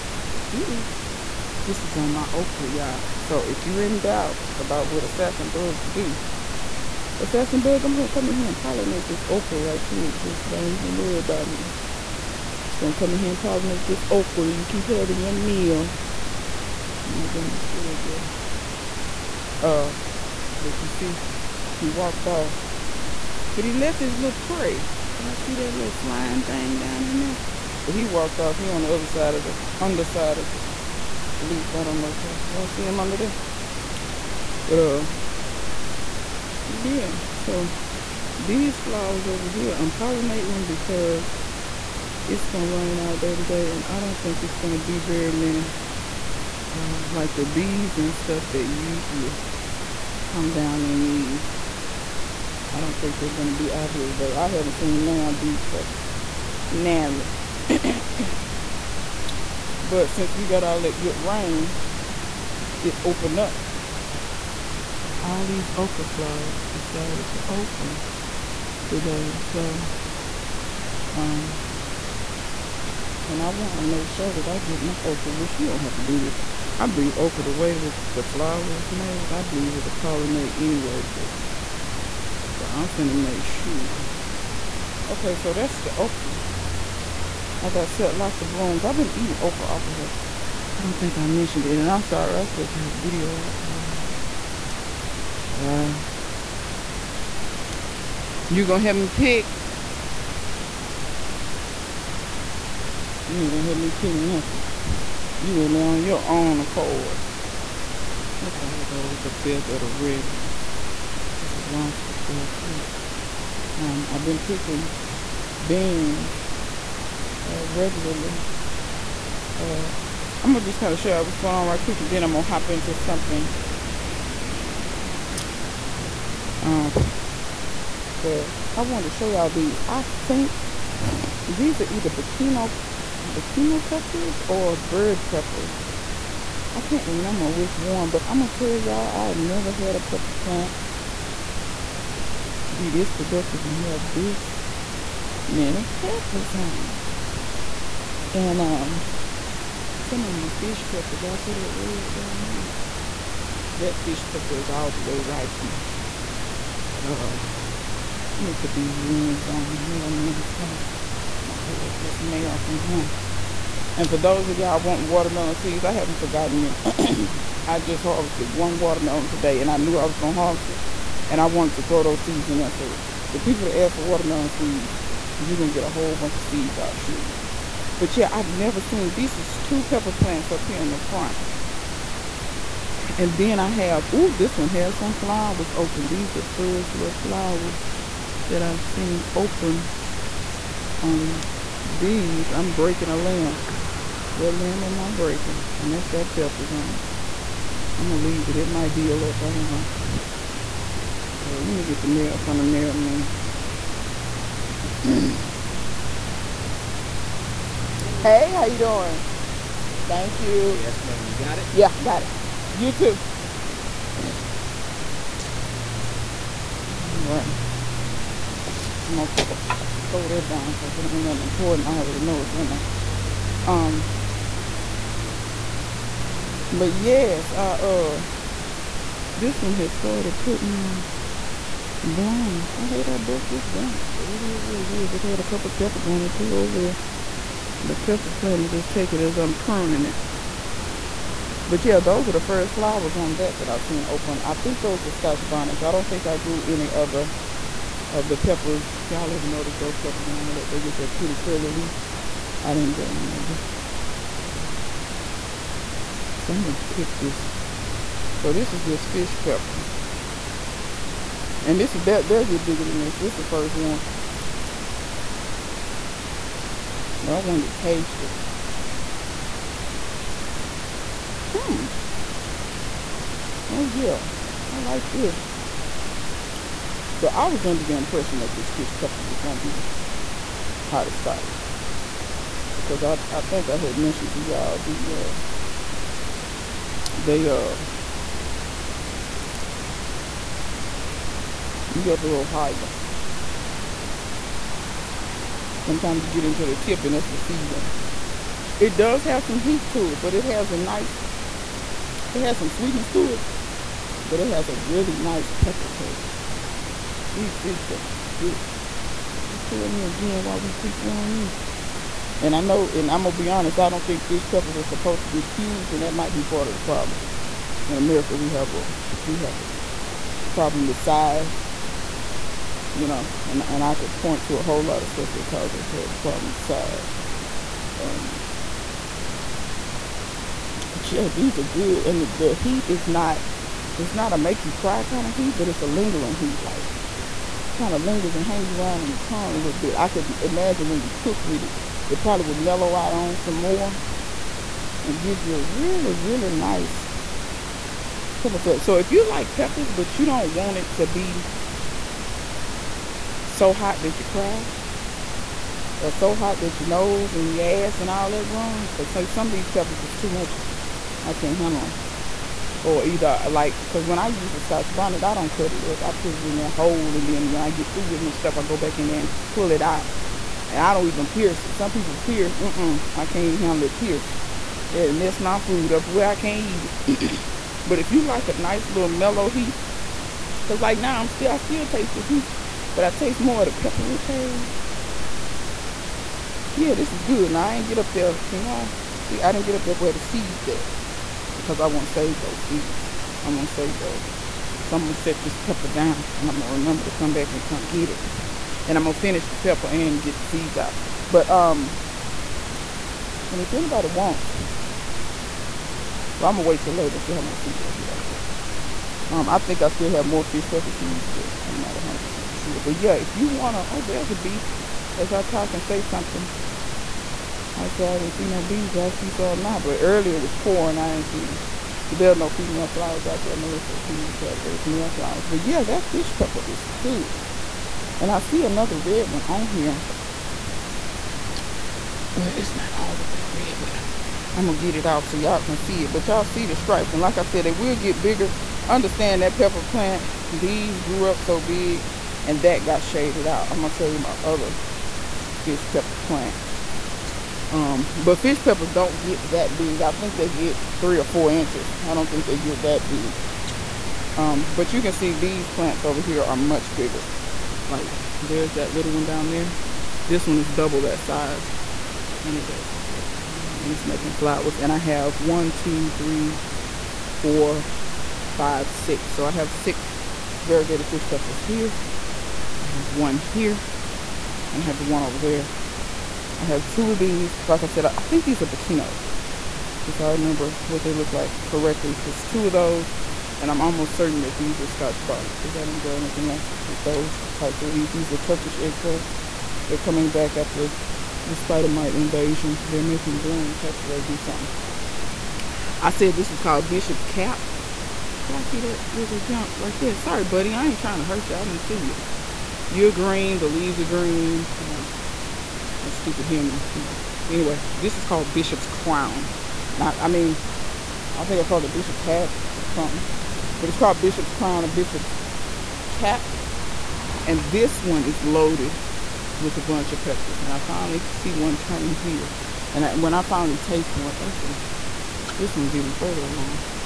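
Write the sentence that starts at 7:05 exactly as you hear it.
But yeah, that fish pepper is good.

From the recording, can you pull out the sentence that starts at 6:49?
Um, I think I still have more fish pepper seeds, but I'm not 100% for sure.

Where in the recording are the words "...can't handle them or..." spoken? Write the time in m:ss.
6:01.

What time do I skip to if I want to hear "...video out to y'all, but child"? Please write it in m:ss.
1:32.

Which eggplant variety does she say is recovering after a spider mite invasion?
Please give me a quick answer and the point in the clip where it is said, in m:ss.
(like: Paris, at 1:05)
Turkish, at 8:08.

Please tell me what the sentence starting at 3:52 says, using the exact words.
I hate I broke this branch, but it is what it is.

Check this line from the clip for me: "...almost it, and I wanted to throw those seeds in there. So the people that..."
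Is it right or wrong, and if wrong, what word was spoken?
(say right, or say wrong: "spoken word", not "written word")
wrong: "harvest", not "almost".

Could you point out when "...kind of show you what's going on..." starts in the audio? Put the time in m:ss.
2:00.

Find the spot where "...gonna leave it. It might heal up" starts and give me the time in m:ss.
3:18.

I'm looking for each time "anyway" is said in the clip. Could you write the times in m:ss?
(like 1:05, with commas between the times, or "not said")
1:20, 8:27.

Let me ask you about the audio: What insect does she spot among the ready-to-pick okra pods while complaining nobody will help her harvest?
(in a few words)
Wasp.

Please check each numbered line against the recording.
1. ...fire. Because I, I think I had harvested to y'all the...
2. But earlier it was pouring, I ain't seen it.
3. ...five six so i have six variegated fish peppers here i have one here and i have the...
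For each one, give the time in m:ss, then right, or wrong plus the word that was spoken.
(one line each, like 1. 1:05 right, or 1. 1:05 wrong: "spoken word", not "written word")
1. 4:41 wrong: "mentioned", not "harvested"
2. 6:59 right
3. 7:48 right.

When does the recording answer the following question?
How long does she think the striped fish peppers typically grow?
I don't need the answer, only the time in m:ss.
7:30.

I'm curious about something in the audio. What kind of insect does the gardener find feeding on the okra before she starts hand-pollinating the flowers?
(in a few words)
Assassin bug.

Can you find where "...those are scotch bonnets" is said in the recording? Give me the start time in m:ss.
4:04.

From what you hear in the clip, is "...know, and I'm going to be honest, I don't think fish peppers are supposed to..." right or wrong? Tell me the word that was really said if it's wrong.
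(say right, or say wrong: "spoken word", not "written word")
right.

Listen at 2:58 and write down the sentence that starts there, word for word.
But yeah, I've never seen, this is two pepper plants up here in the front.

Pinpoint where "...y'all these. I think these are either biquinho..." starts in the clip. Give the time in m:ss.
2:09.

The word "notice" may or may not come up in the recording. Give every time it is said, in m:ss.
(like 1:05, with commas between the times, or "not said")
4:09.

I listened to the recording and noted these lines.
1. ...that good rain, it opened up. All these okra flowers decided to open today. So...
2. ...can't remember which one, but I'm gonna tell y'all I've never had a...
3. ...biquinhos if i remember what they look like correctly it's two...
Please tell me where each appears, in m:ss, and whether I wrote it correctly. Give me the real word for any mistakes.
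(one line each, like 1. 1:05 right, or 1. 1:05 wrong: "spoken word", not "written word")
1. 1:00 right
2. 2:16 right
3. 7:58 right.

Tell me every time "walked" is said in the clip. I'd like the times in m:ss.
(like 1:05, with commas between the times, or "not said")
0:21, 0:28.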